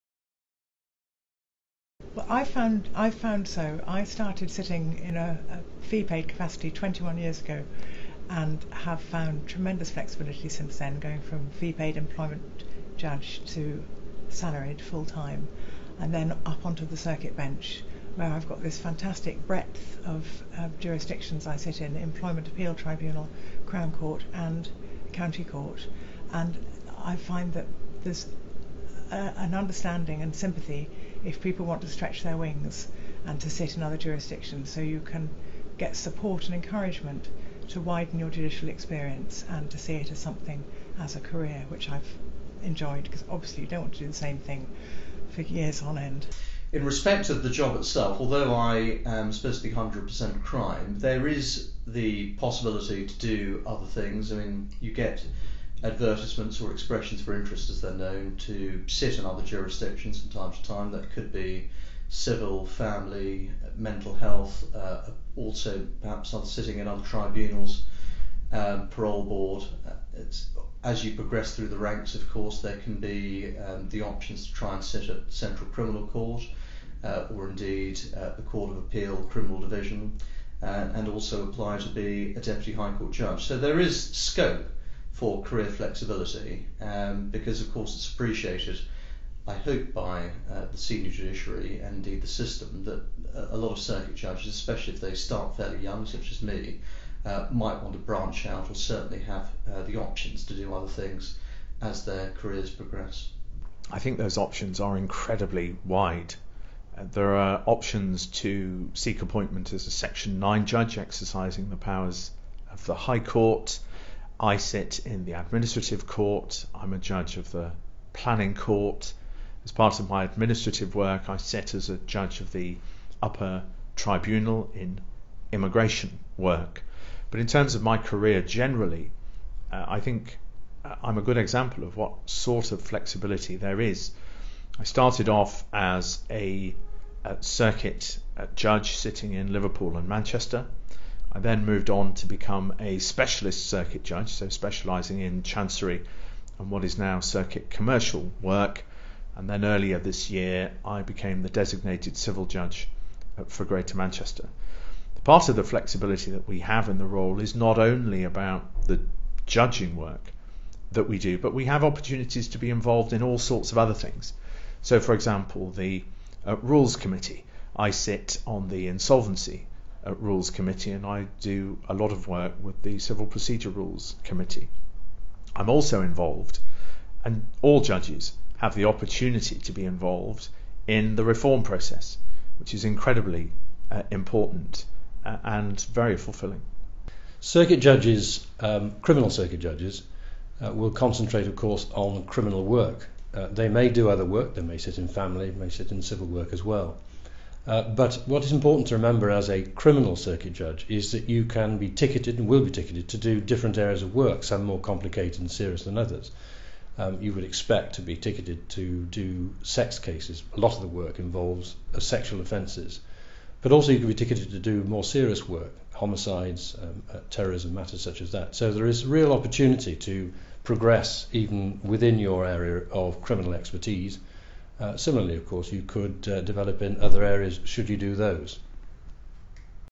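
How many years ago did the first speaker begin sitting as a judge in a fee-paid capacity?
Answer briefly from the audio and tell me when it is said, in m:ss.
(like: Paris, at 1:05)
21, at 0:06.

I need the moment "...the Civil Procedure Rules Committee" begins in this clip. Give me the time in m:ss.
2:52.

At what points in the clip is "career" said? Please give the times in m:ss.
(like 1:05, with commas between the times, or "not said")
0:41, 1:25, 1:42, 2:07.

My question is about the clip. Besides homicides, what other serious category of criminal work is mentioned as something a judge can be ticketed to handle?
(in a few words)
Terrorism.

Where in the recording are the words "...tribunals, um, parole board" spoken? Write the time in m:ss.
1:07.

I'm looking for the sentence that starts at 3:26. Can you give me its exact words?
Um, you would expect to be ticketed to do sex cases.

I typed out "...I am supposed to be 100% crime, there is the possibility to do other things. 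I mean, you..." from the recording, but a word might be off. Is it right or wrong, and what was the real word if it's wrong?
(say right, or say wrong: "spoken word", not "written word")
right.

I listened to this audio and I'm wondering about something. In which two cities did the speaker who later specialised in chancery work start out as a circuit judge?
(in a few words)
Liverpool and Manchester.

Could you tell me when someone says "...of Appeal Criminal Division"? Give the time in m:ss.
1:18.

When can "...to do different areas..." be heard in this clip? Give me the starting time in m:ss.
3:23.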